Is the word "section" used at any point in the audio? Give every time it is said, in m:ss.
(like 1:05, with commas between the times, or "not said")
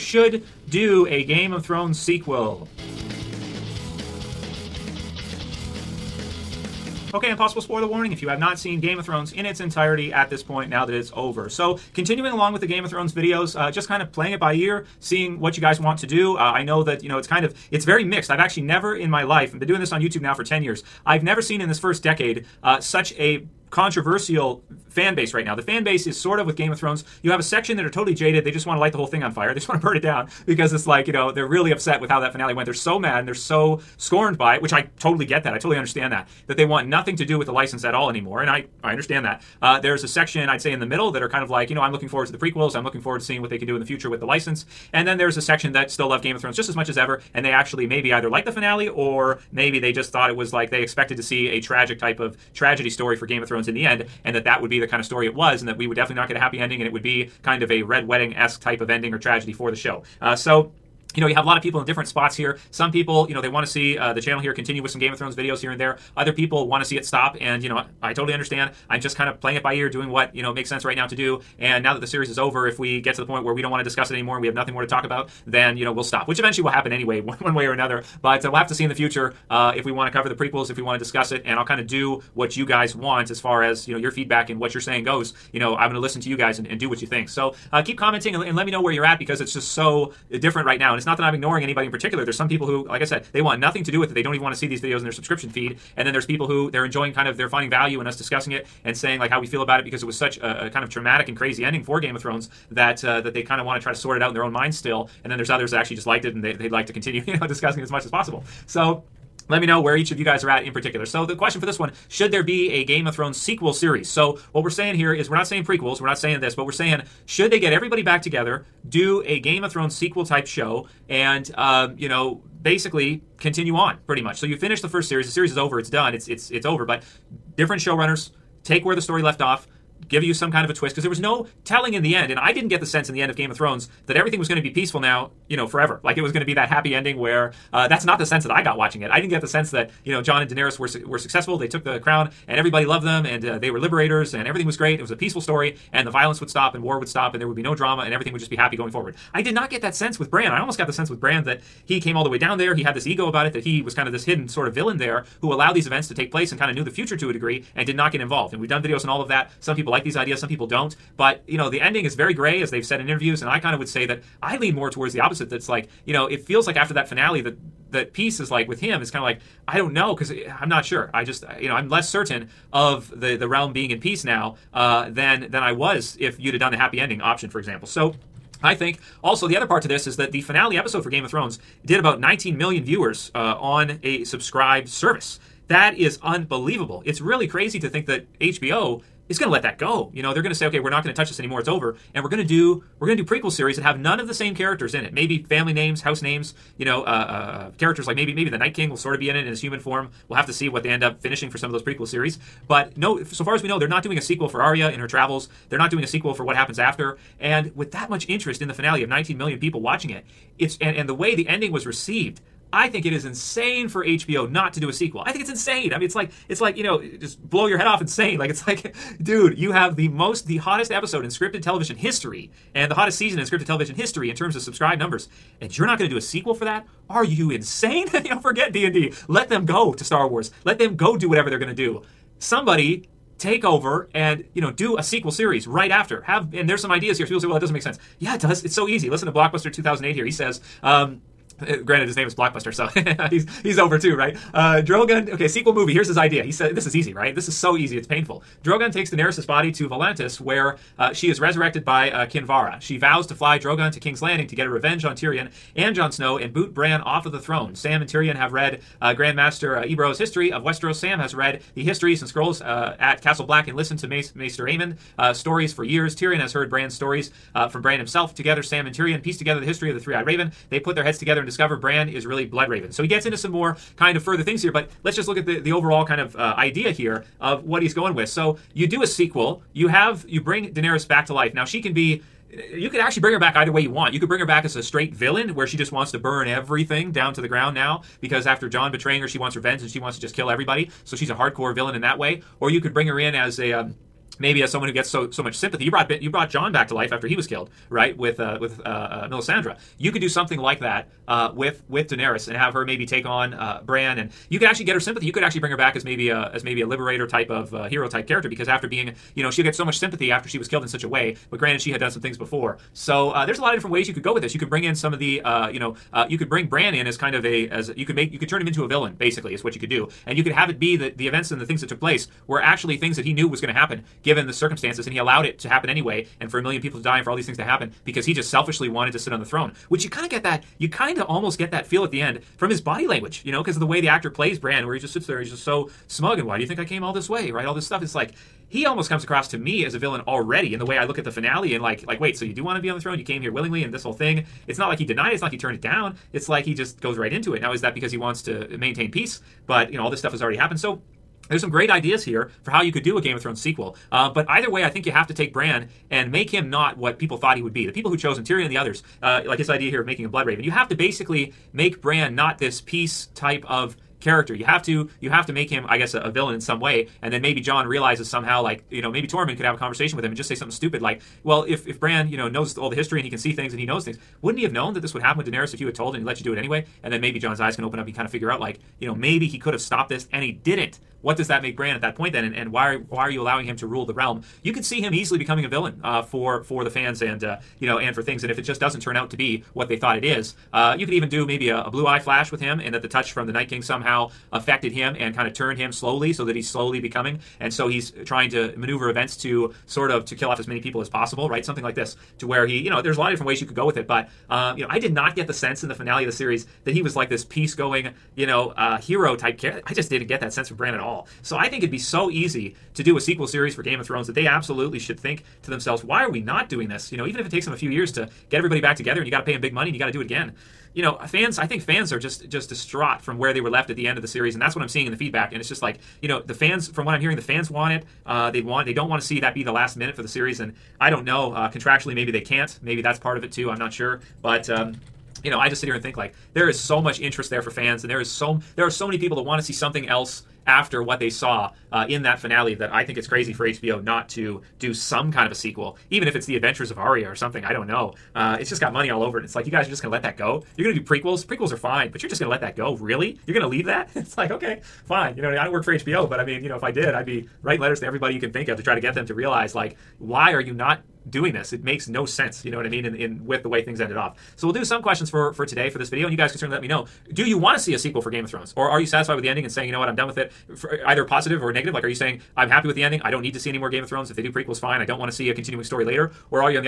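0:27, 0:40, 0:45.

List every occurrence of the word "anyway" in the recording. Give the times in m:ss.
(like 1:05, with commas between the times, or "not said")
1:16, 5:25, 6:16.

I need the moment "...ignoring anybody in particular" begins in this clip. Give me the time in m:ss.
1:31.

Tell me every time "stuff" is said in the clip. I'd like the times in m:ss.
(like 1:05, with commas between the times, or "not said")
5:37, 5:50.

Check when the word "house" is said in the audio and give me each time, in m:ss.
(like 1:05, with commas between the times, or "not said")
3:16.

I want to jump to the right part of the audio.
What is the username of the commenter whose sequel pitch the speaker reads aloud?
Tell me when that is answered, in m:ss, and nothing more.
3:59.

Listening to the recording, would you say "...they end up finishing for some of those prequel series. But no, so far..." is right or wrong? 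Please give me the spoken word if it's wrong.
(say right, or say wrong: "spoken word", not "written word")
right.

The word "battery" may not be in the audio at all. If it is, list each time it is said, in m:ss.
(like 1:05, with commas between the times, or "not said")
not said.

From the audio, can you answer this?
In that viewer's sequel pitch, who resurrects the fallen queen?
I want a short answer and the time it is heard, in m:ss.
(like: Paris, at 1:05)
Kinvara, at 4:12.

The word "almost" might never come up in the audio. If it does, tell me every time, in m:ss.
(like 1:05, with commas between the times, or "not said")
2:30, 5:31, 5:38.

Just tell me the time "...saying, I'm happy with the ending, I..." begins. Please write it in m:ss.
7:52.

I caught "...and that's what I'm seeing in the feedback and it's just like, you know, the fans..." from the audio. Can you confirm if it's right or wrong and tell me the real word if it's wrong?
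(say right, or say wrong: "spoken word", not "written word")
right.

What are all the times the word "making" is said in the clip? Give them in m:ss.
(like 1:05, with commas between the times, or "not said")
6:00.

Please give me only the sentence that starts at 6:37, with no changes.
And so he's trying to maneuver events to sort of to kill off as many people as possible, right?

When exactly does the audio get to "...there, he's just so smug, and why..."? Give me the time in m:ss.
5:35.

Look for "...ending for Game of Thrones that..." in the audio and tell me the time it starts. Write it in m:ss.
1:41.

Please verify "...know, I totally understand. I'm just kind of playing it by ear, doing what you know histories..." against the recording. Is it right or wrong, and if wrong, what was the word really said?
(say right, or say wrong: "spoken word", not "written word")
wrong: "makes", not "histories".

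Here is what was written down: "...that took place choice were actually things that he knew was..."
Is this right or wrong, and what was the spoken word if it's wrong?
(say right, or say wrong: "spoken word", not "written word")
right.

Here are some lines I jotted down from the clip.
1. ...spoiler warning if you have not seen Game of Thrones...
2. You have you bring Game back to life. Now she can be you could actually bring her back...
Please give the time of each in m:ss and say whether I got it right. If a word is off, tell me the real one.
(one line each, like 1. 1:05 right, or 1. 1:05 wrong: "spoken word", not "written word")
1. 0:07 right
2. 4:39 wrong: "Daenerys", not "Game".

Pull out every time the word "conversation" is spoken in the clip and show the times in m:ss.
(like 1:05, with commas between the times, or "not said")
6:09.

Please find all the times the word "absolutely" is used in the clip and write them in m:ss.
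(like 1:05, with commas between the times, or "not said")
6:54.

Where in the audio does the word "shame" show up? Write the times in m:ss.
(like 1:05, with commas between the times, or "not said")
not said.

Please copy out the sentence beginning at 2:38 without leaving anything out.
And we've done videos on all of that.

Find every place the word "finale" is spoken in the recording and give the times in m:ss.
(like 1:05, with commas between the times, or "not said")
0:32, 0:48, 2:47, 3:00, 3:28, 5:41, 6:45, 7:22.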